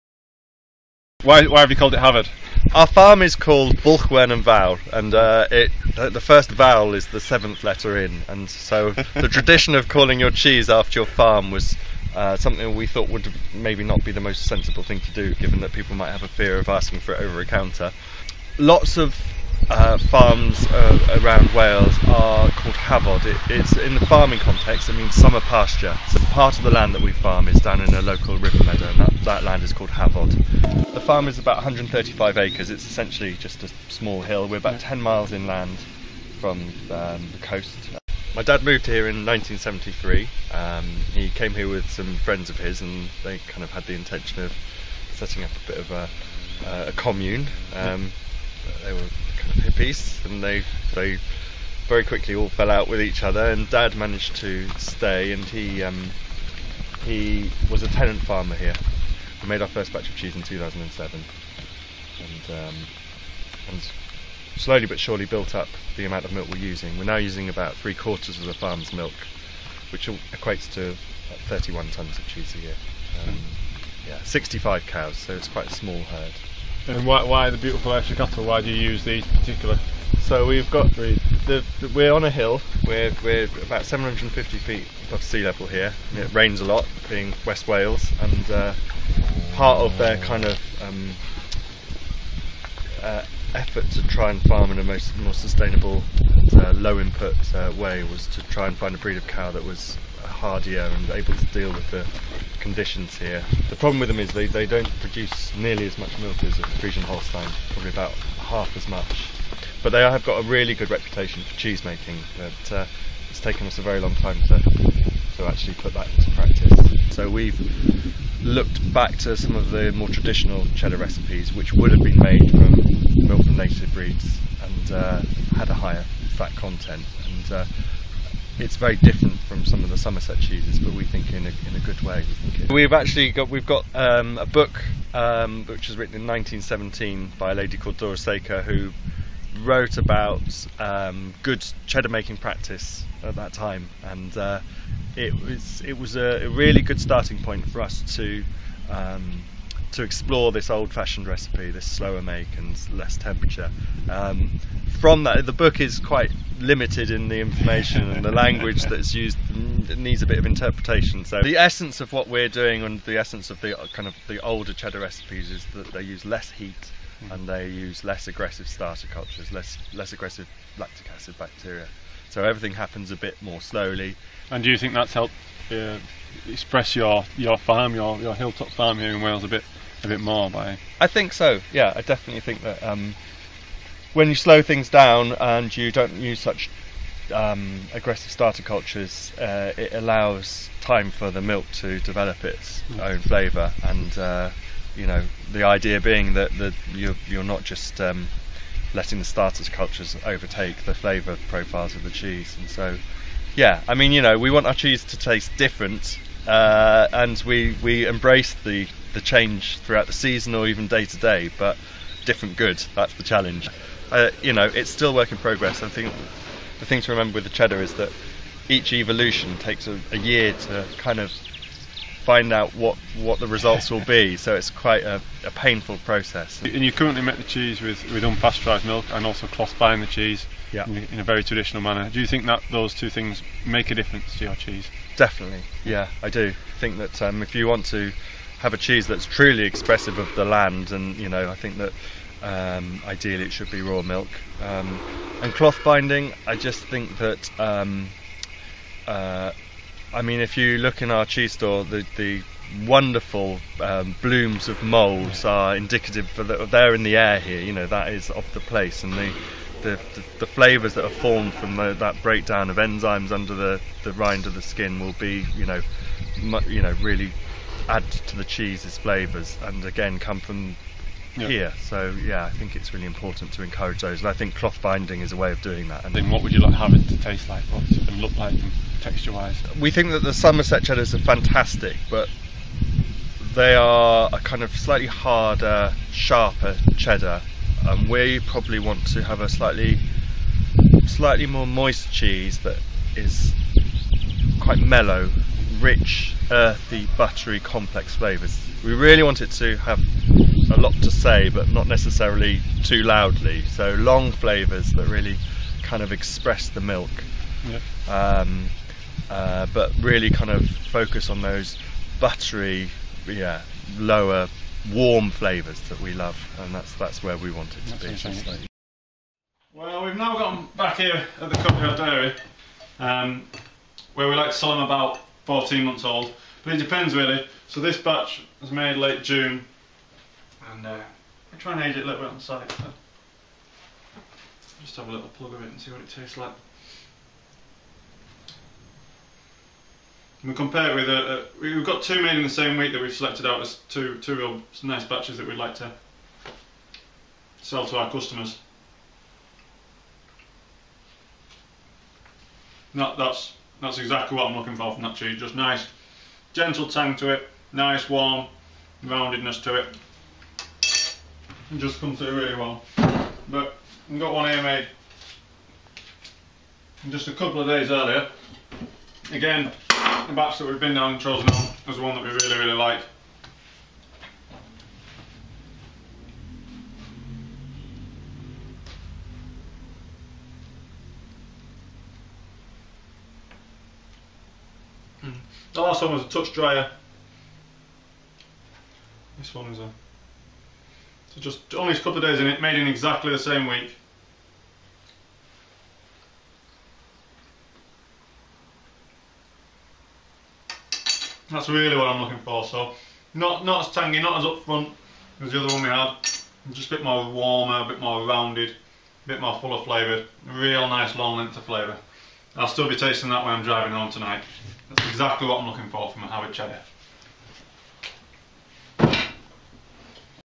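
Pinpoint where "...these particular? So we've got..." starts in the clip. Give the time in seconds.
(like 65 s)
79 s.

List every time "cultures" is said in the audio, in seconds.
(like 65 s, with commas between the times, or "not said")
169 s, 188 s, 199 s.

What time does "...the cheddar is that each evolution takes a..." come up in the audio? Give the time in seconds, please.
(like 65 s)
217 s.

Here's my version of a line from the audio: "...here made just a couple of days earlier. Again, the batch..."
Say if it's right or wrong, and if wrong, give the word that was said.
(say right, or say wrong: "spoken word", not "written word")
right.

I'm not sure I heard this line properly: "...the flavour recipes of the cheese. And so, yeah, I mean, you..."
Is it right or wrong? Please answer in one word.
wrong.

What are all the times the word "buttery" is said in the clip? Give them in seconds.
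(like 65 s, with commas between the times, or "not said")
297 s, 312 s.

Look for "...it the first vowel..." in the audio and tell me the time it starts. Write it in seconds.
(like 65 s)
5 s.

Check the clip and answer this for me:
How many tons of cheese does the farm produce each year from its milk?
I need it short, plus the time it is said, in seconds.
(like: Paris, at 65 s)
31 tons, at 71 s.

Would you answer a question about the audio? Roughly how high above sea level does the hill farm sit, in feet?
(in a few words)
750 feet.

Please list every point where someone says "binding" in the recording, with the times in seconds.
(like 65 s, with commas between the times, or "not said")
229 s, 245 s, 274 s.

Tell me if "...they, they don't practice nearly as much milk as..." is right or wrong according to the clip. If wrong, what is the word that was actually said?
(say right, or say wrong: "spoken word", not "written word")
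wrong: "produce", not "practice".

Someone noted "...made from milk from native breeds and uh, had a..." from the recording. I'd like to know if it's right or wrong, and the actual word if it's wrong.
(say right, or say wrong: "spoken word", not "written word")
right.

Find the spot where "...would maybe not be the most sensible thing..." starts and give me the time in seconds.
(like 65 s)
13 s.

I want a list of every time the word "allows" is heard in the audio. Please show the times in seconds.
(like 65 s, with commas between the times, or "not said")
189 s.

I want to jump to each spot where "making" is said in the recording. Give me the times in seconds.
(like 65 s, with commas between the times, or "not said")
111 s, 142 s.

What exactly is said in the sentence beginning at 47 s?
Um, they were kind of hippies, and they they very quickly all fell out with each other.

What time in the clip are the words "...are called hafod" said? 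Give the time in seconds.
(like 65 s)
22 s.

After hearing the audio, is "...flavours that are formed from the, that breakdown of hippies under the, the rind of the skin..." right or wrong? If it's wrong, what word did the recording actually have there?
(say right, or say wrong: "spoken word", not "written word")
wrong: "enzymes", not "hippies".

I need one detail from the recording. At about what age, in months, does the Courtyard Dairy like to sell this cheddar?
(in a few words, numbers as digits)
14 months.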